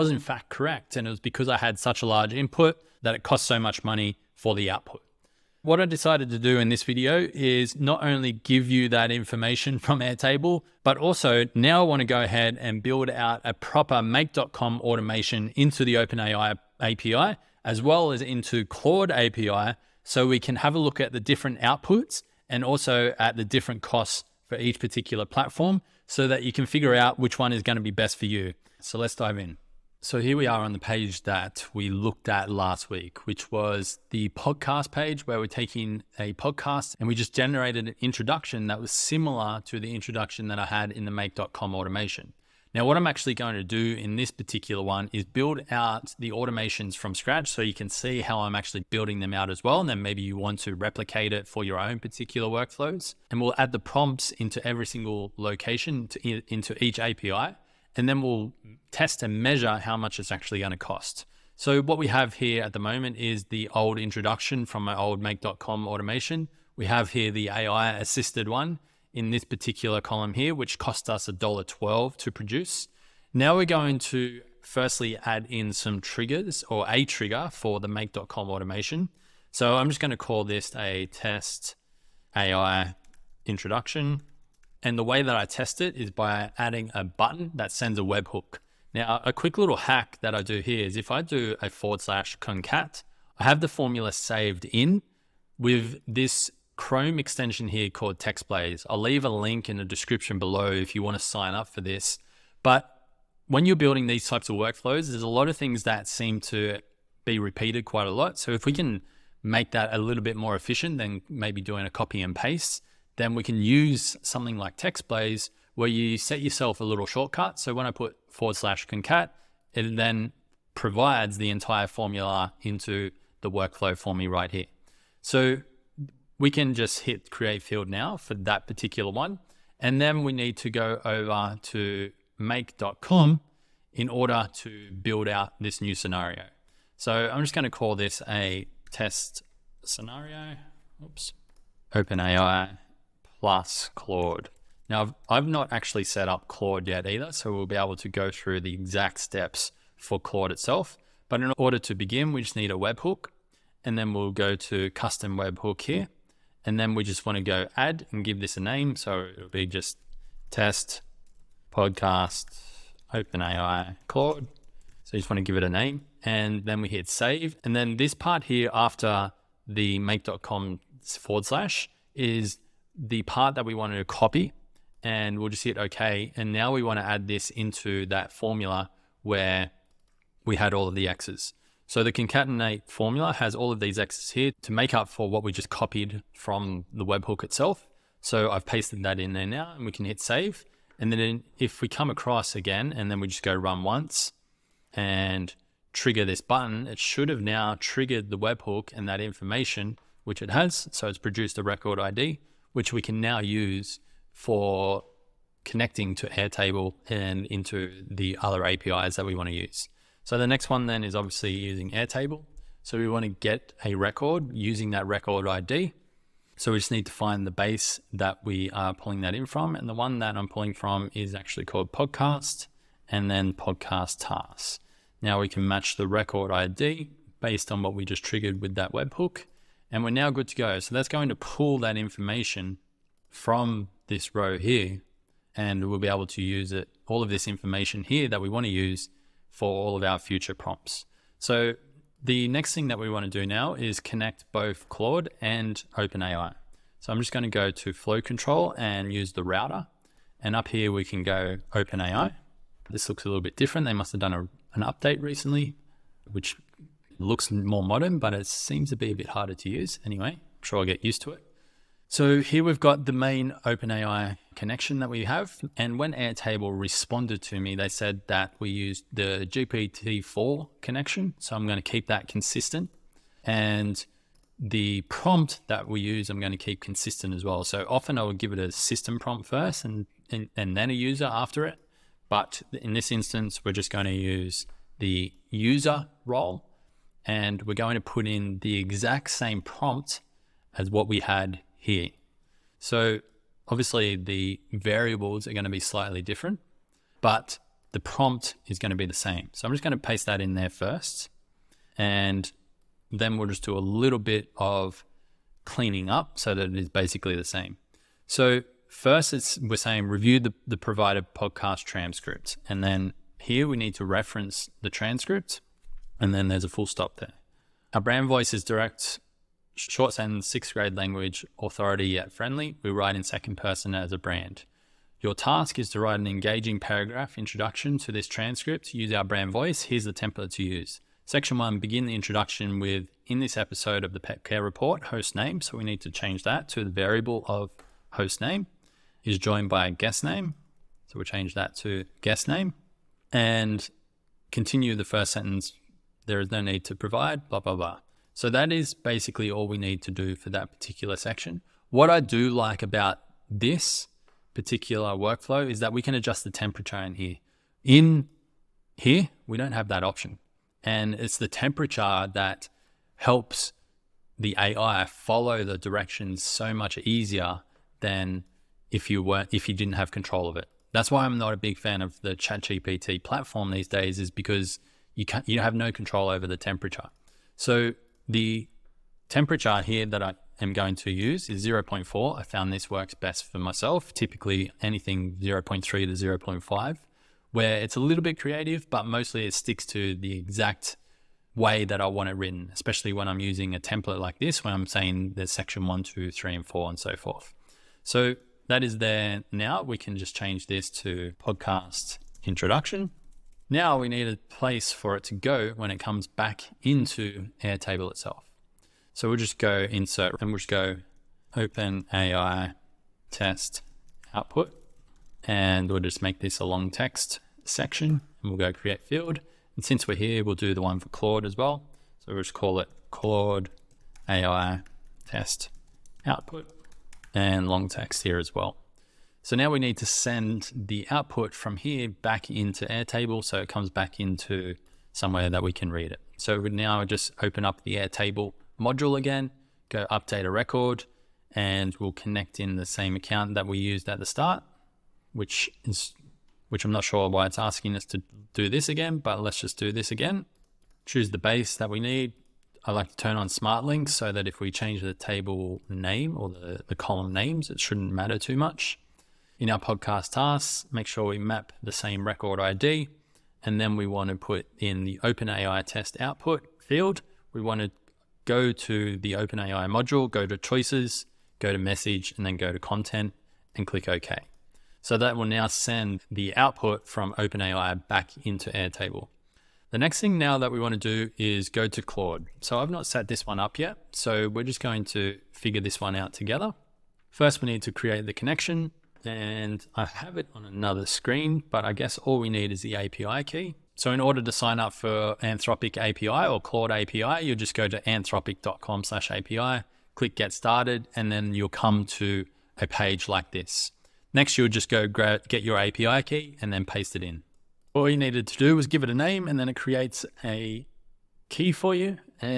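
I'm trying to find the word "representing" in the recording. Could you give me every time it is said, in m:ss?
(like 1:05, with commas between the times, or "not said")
not said.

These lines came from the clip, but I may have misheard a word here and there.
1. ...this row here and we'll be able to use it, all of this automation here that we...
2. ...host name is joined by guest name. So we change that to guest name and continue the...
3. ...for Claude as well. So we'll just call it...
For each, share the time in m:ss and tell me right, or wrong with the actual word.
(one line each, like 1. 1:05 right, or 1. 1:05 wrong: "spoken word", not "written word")
1. 3:54 wrong: "information", not "automation"
2. 5:38 right
3. 7:00 right.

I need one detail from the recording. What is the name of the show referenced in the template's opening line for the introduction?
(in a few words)
the pet care report.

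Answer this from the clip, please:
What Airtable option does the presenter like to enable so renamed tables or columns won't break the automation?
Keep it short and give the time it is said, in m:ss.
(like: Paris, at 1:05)
smart links, at 7:33.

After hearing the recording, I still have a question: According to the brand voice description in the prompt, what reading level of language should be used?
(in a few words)
sixth grade.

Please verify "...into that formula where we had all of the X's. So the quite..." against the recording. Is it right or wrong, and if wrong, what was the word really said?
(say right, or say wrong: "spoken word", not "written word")
wrong: "concatenate", not "quite".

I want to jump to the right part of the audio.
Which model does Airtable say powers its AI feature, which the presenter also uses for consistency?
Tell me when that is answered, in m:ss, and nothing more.
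4:29.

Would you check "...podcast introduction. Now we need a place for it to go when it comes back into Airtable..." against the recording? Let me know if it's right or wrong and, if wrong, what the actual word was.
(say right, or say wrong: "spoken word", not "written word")
right.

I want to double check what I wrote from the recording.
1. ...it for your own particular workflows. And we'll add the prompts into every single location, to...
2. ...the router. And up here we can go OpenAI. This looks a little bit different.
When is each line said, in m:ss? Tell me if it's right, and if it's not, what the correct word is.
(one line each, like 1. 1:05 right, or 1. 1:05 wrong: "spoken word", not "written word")
1. 0:51 right
2. 4:09 right.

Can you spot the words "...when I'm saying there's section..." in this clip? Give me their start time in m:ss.
6:34.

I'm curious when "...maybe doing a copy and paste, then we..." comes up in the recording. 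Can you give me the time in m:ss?
1:51.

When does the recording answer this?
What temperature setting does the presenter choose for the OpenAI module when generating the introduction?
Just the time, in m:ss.
6:21.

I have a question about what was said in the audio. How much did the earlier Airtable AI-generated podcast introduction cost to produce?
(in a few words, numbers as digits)
$1.12.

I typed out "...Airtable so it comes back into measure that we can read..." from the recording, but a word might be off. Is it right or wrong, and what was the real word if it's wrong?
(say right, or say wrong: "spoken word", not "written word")
wrong: "somewhere", not "measure".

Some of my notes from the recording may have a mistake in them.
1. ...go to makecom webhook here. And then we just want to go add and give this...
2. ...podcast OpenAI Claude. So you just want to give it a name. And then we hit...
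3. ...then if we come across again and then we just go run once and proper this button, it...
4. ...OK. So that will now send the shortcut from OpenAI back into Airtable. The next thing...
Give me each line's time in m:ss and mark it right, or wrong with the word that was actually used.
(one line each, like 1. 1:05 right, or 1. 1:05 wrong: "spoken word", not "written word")
1. 2:34 wrong: "custom", not "makecom"
2. 2:41 right
3. 3:11 wrong: "trigger", not "proper"
4. 7:54 wrong: "output", not "shortcut".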